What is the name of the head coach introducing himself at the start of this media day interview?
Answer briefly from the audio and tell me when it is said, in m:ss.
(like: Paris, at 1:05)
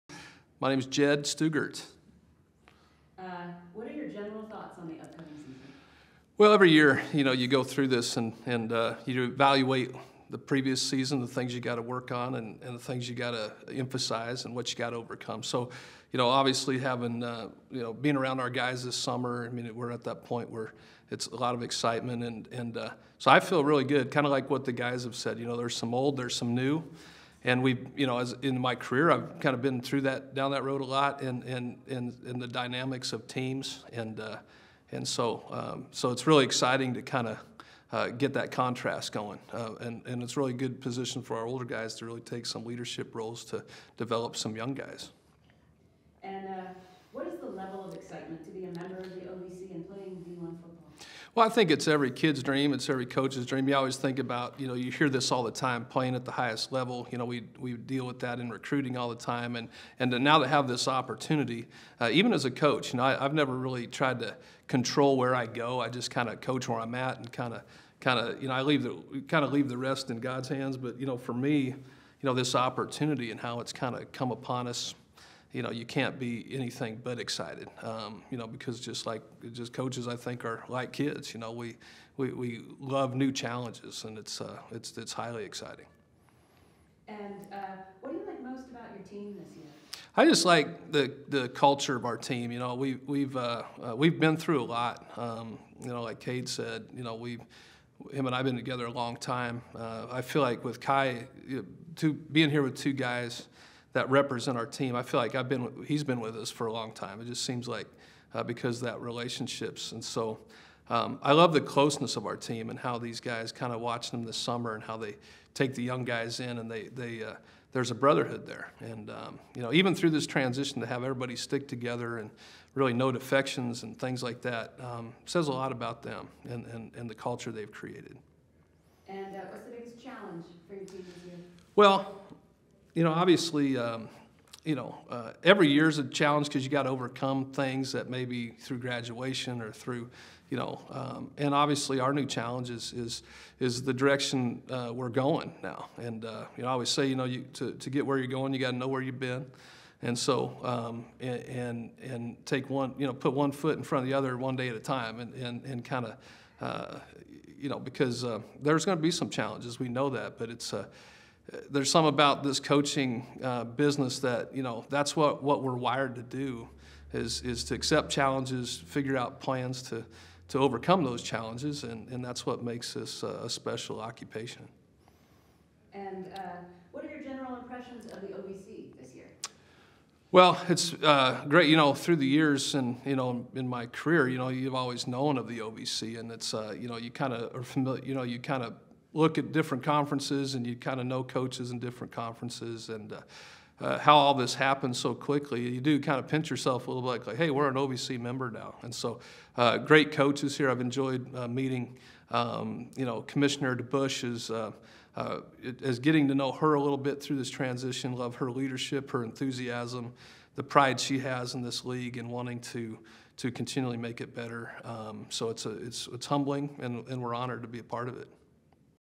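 Jed Stugart, at 0:00.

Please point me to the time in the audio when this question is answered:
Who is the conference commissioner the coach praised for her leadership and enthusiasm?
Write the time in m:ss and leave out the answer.
3:23.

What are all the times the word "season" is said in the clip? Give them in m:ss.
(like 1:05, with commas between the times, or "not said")
0:05, 0:10.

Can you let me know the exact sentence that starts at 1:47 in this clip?
It just seems like uh, because that relationships and so.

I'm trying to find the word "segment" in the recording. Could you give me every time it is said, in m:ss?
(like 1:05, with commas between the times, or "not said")
not said.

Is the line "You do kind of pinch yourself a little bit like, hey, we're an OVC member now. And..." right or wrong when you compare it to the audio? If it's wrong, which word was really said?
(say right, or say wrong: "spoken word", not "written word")
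right.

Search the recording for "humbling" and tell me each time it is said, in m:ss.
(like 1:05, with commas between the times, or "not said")
3:36.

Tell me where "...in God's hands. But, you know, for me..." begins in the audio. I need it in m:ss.
1:10.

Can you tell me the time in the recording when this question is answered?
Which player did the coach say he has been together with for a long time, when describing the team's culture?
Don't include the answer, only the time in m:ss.
1:36.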